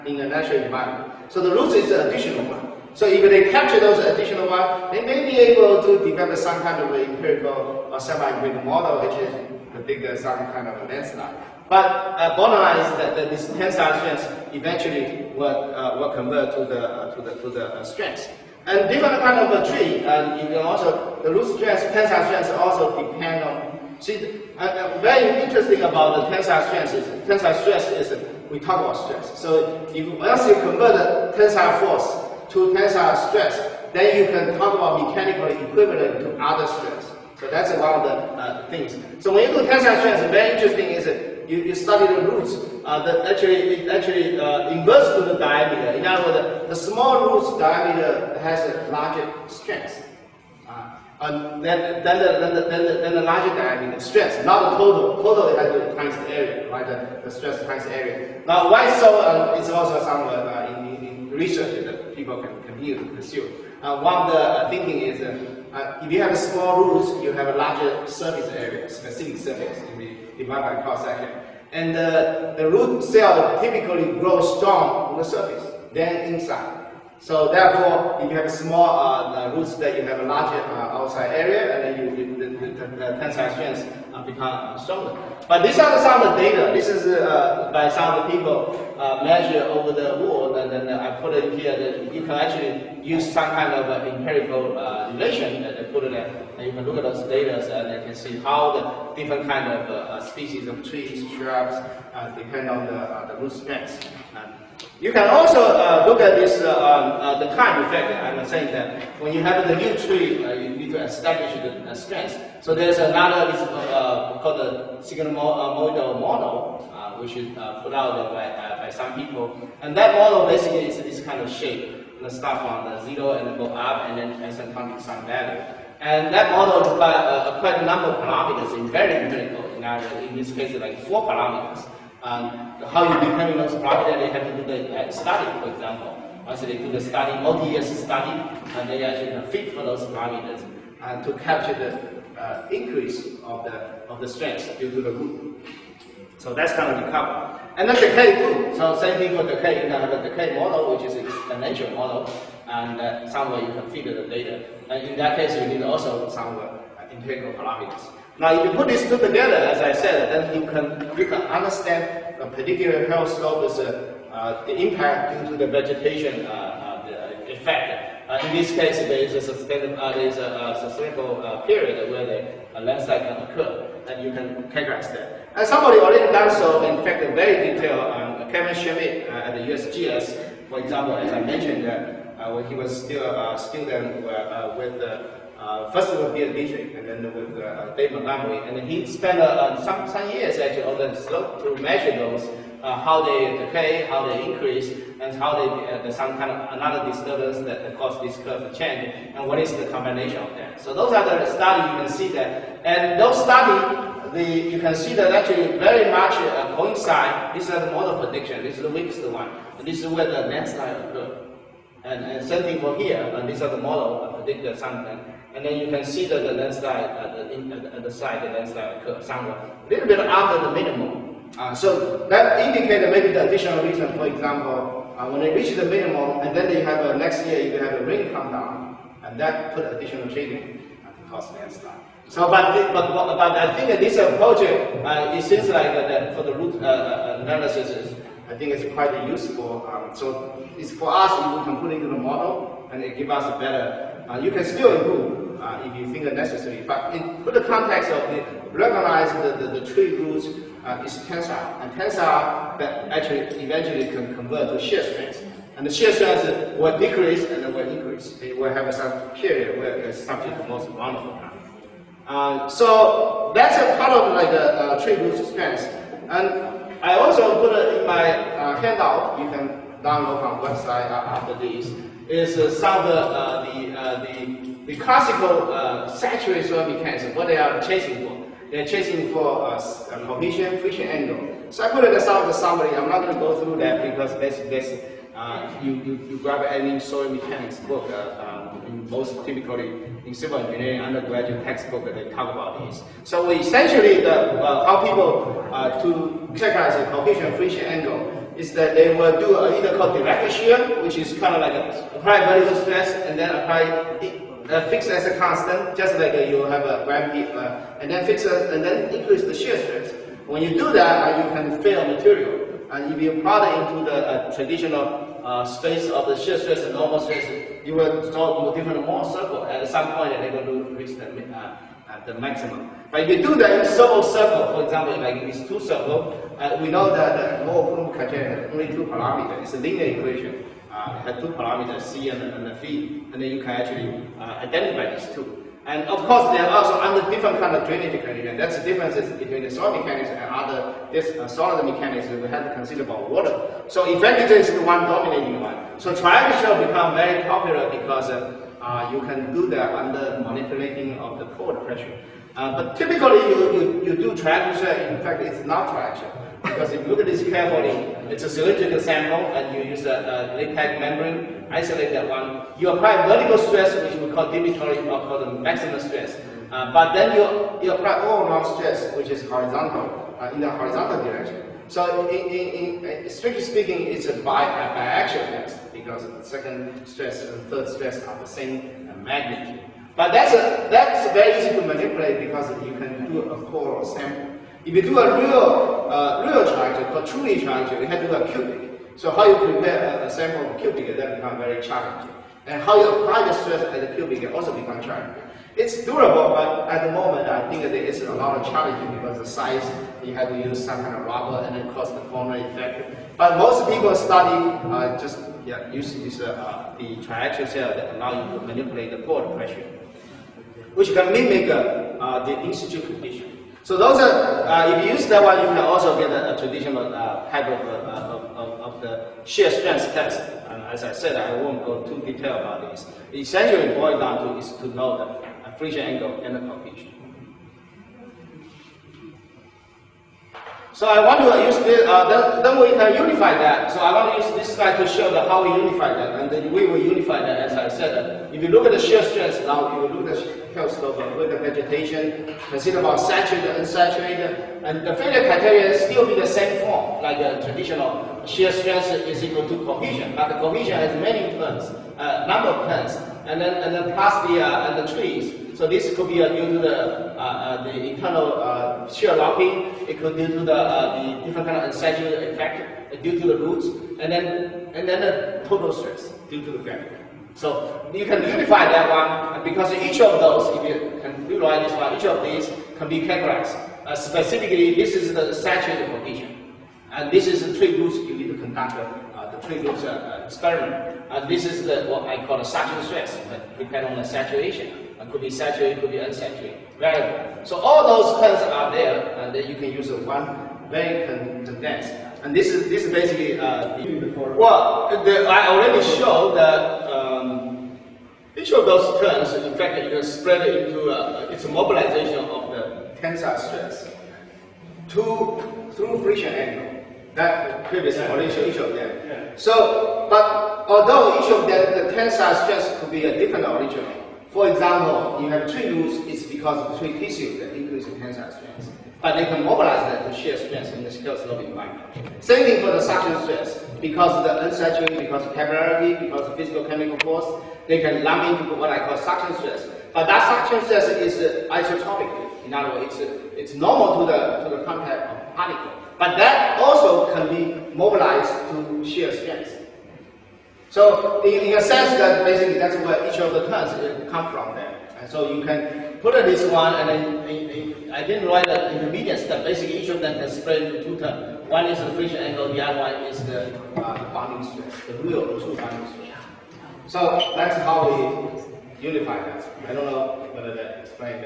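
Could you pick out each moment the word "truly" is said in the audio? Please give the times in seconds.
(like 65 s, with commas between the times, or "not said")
387 s.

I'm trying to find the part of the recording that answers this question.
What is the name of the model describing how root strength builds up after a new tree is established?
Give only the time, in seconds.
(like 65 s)
115 s.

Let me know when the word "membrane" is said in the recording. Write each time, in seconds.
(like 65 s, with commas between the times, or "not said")
361 s.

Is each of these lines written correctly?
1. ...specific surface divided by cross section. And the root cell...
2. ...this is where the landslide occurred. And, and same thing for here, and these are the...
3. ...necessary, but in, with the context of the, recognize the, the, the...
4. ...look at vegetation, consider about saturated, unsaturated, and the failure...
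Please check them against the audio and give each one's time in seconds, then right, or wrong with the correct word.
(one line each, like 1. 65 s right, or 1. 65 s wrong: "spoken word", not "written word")
1. 68 s right
2. 209 s right
3. 246 s right
4. 441 s right.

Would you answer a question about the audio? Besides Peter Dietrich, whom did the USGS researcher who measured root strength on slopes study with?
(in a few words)
Dave Montgomery.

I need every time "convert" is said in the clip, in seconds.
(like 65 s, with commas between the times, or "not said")
16 s, 30 s, 254 s.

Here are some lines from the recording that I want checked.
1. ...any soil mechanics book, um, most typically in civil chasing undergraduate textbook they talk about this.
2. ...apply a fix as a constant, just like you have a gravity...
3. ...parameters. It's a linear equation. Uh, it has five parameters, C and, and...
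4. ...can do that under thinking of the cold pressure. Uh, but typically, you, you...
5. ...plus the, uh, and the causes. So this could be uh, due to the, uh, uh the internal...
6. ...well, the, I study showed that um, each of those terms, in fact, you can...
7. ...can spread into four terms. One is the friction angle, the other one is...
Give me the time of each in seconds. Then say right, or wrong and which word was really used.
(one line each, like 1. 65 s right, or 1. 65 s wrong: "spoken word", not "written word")
1. 286 s wrong: "engineering", not "chasing"
2. 303 s right
3. 329 s wrong: "two", not "five"
4. 349 s wrong: "manipulating", not "thinking"
5. 454 s wrong: "trees", not "causes"
6. 494 s wrong: "already", not "study"
7. 550 s wrong: "two", not "four".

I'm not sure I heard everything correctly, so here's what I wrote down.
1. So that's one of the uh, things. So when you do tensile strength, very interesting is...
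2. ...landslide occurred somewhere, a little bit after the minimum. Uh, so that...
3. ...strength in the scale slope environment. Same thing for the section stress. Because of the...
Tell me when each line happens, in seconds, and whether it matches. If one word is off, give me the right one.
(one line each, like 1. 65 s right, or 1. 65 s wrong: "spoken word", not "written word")
1. 37 s right
2. 218 s right
3. 520 s wrong: "suction", not "section".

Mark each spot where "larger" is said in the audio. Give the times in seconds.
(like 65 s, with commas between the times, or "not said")
48 s, 53 s, 67 s, 80 s.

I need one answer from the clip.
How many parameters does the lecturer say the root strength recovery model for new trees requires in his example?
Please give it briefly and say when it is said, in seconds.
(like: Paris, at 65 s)
4, at 131 s.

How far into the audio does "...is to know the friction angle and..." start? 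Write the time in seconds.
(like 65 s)
424 s.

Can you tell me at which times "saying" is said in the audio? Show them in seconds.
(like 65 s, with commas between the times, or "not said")
108 s.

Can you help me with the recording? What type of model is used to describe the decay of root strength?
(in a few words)
exponential model.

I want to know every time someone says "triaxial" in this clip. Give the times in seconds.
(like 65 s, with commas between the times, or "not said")
346 s, 407 s.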